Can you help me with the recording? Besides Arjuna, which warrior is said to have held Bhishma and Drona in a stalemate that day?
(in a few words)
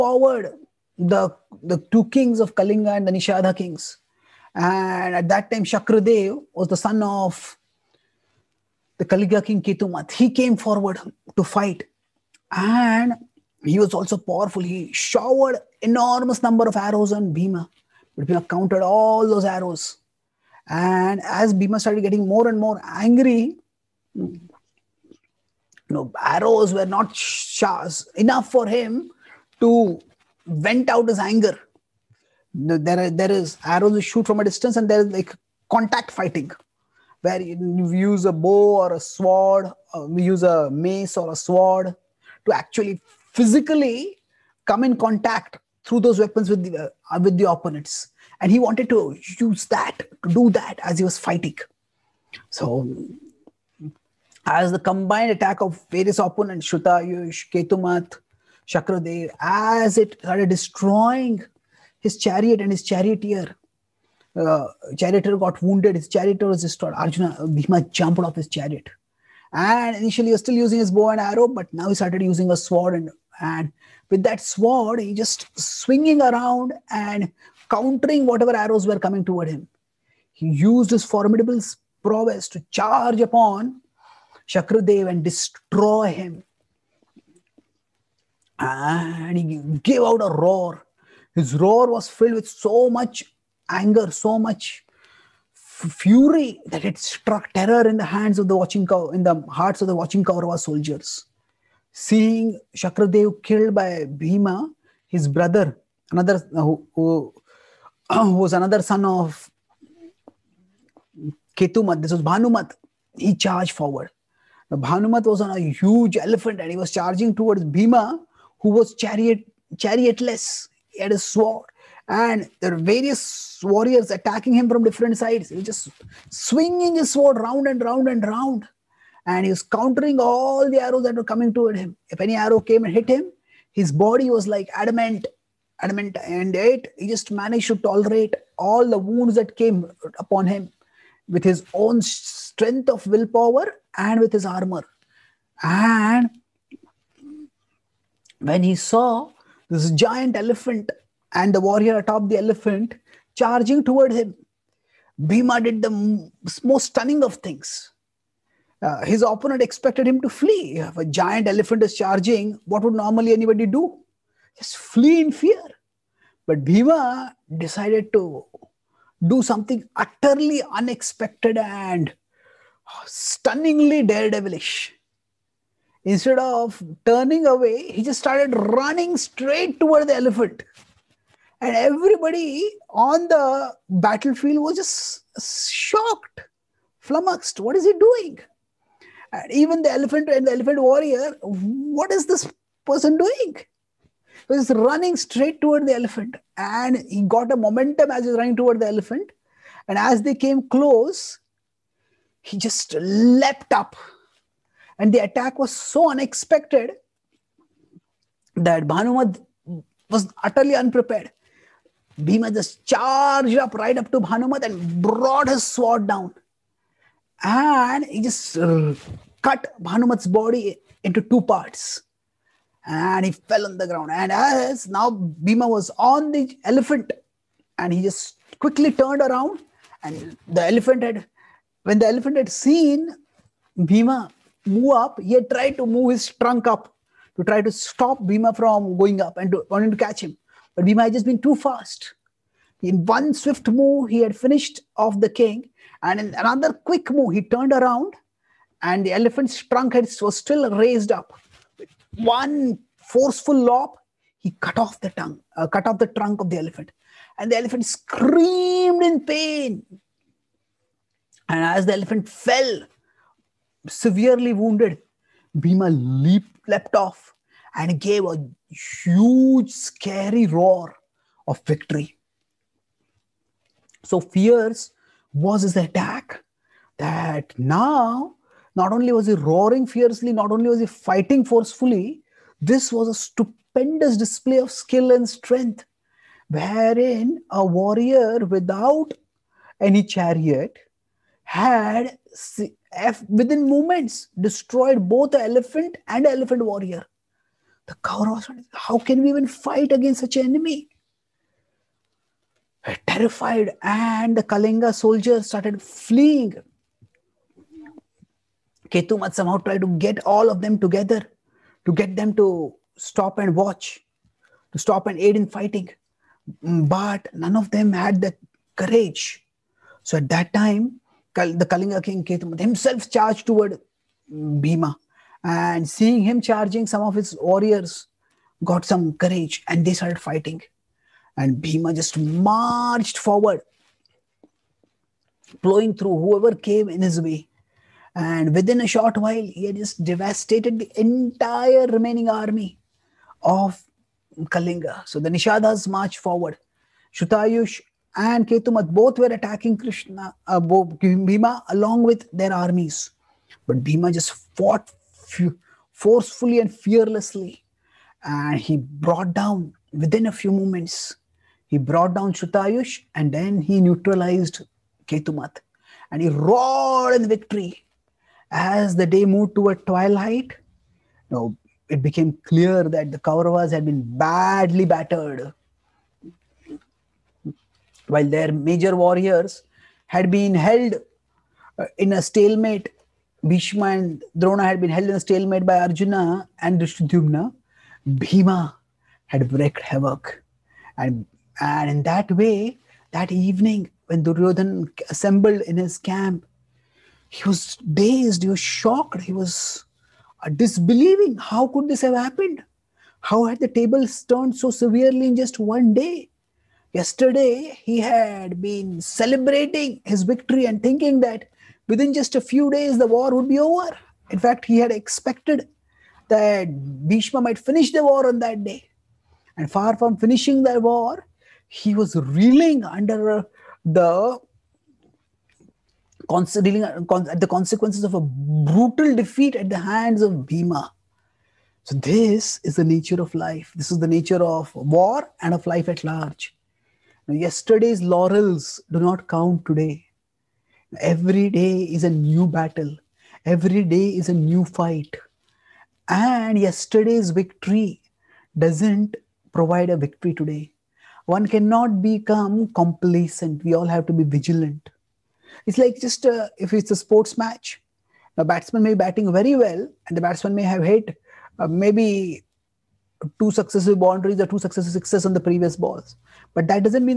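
Drishtadhyumna.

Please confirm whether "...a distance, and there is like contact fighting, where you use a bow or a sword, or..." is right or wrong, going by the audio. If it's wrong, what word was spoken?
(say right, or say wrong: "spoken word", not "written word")
right.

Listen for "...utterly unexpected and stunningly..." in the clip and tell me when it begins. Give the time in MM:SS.
02:49.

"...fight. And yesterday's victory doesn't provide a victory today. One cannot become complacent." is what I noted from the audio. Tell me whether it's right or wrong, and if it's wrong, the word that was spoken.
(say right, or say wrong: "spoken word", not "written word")
right.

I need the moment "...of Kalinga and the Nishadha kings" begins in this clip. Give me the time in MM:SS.
00:02.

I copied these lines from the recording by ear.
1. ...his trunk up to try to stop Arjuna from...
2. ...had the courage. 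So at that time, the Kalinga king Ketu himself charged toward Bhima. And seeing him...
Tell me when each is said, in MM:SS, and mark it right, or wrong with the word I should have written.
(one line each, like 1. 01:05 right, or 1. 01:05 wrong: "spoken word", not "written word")
1. 03:56 wrong: "Bhima", not "Arjuna"
2. 05:17 right.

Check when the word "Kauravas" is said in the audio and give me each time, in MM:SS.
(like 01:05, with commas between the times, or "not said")
01:40, 04:57, 06:13.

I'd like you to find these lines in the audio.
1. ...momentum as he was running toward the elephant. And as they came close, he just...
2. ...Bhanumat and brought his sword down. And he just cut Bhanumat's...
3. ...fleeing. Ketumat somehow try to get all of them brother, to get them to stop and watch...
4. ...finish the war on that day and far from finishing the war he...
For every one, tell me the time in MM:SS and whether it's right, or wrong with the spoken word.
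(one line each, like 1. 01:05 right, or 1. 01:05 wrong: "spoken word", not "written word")
1. 03:17 right
2. 03:34 right
3. 05:05 wrong: "together", not "brother"
4. 06:57 right.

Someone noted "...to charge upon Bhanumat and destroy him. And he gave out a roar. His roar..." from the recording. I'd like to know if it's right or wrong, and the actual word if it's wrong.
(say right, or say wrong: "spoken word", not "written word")
wrong: "Shakrudev", not "Bhanumat".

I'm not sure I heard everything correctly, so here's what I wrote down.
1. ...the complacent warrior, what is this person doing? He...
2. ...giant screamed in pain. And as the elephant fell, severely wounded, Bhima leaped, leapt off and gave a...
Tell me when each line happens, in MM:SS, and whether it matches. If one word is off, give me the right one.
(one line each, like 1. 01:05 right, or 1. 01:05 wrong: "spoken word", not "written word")
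1. 03:10 wrong: "elephant", not "complacent"
2. 04:17 wrong: "elephant", not "giant".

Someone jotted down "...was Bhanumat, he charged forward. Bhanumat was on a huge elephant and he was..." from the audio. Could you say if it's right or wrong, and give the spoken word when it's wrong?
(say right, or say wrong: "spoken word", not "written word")
right.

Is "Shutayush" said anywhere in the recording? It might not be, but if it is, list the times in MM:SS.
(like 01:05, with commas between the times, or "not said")
00:56, 05:47, 06:02.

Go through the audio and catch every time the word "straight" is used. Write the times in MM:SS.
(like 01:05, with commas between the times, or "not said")
02:59, 03:15.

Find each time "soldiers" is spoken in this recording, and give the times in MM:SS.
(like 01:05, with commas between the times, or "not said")
01:40, 05:04.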